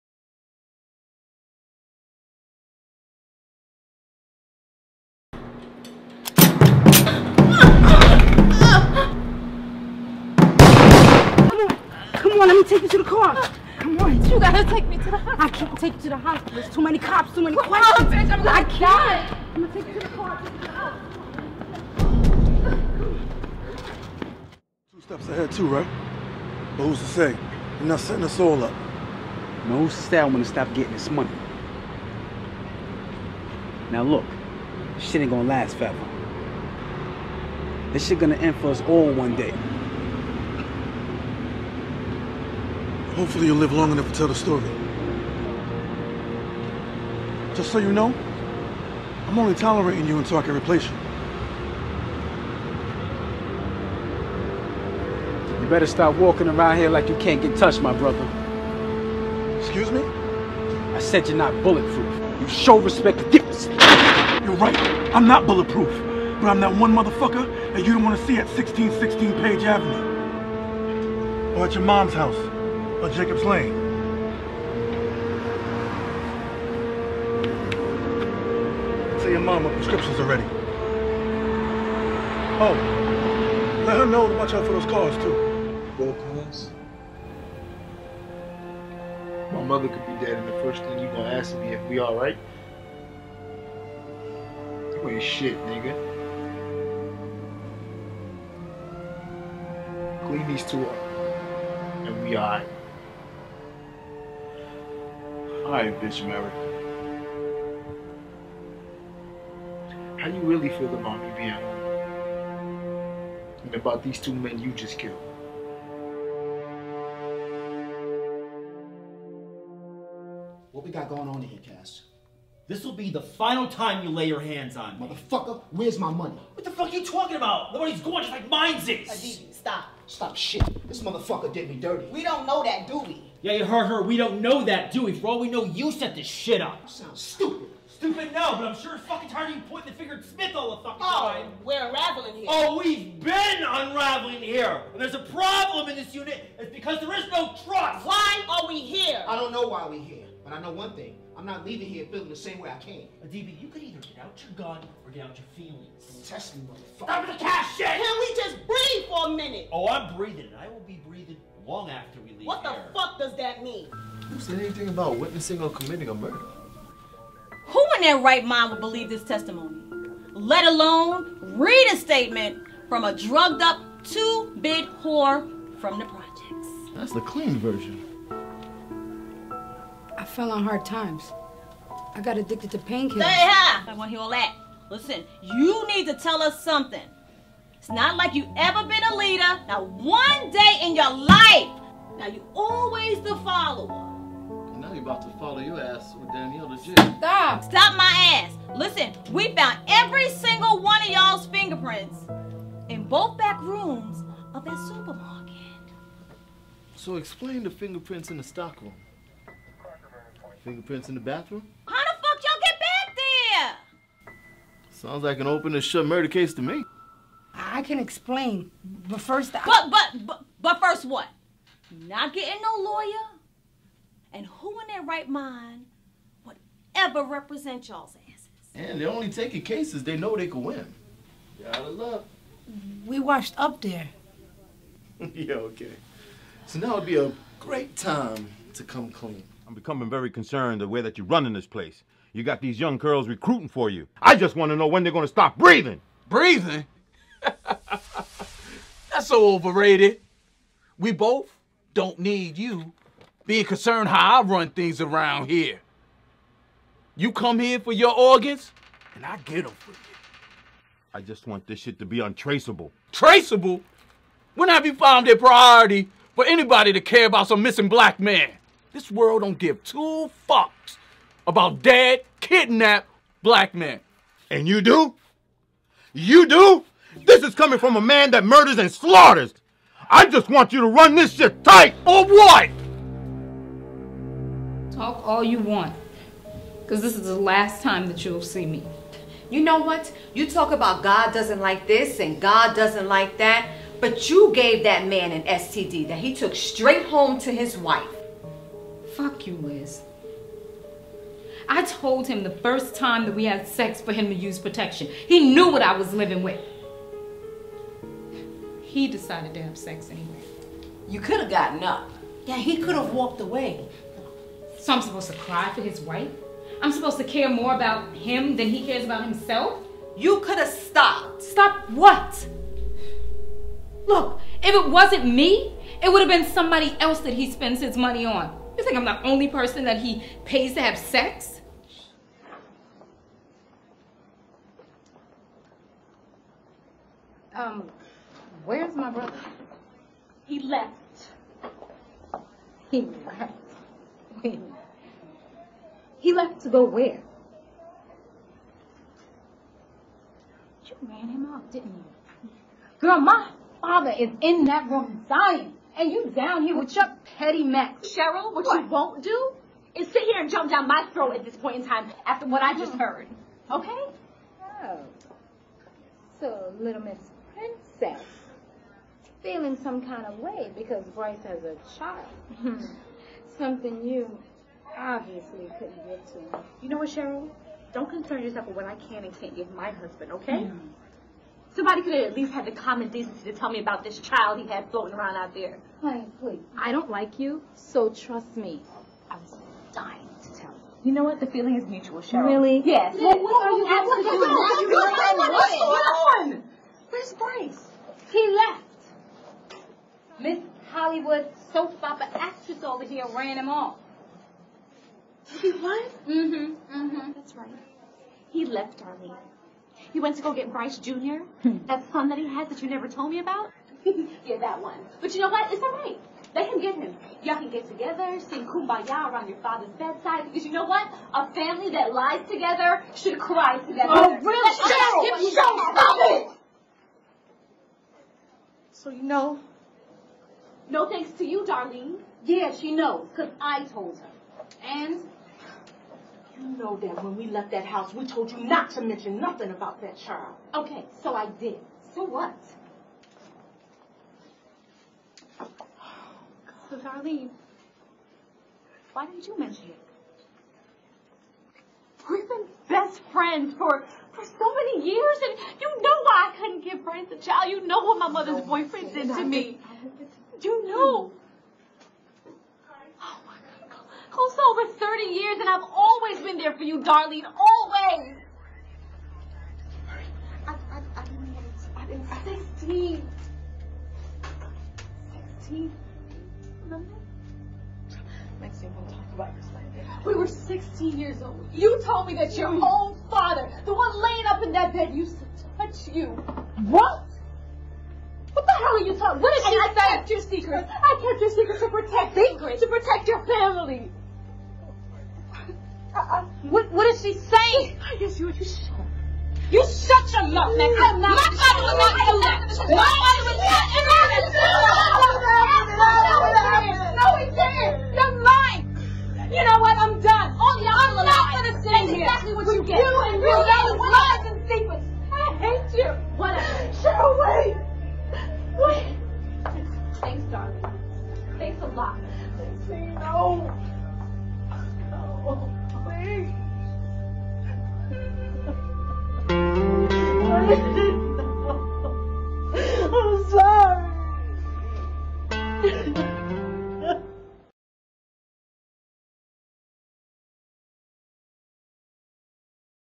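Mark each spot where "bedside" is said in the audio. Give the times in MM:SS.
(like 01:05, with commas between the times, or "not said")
06:59.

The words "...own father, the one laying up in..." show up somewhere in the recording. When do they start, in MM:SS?
08:02.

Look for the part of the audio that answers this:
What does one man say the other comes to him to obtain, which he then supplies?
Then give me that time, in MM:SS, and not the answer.
04:18.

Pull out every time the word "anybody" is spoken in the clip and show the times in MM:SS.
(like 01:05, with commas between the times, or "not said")
04:26.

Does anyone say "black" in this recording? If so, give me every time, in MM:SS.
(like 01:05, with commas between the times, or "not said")
04:27, 04:33.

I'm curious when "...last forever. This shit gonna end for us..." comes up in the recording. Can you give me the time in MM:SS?
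00:35.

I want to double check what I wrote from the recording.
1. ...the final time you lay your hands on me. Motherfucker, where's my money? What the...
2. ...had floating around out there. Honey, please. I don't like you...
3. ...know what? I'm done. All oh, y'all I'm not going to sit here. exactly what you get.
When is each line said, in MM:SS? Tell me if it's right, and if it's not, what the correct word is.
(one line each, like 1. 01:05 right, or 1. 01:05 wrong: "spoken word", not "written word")
1. 02:03 right
2. 06:24 right
3. 08:29 right.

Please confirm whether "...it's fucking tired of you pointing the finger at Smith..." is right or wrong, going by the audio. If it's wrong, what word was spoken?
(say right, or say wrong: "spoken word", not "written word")
right.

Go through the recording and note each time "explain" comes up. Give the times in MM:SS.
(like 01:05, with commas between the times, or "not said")
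03:27, 03:37.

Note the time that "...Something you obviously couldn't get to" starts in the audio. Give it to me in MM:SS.
06:13.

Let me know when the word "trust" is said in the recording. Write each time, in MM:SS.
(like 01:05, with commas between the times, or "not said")
02:27, 06:28.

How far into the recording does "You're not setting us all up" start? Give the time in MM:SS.
00:27.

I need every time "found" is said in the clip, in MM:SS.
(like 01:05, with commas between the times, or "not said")
03:19, 04:24.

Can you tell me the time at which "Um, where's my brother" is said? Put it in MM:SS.
05:37.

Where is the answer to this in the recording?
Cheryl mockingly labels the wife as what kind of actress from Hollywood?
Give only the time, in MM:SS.
06:41.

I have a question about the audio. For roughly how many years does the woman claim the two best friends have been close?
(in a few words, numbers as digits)
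Over 30.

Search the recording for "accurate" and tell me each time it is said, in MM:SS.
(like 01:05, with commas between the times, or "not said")
not said.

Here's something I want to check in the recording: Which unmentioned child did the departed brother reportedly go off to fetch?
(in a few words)
Bryce Jr.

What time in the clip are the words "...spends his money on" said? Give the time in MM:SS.
05:27.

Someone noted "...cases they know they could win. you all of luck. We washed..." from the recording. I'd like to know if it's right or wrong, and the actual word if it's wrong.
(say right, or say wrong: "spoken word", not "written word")
right.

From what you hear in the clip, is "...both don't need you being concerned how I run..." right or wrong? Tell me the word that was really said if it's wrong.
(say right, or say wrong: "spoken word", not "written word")
right.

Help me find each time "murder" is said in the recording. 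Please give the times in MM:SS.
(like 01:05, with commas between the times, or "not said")
02:46, 03:36, 04:38.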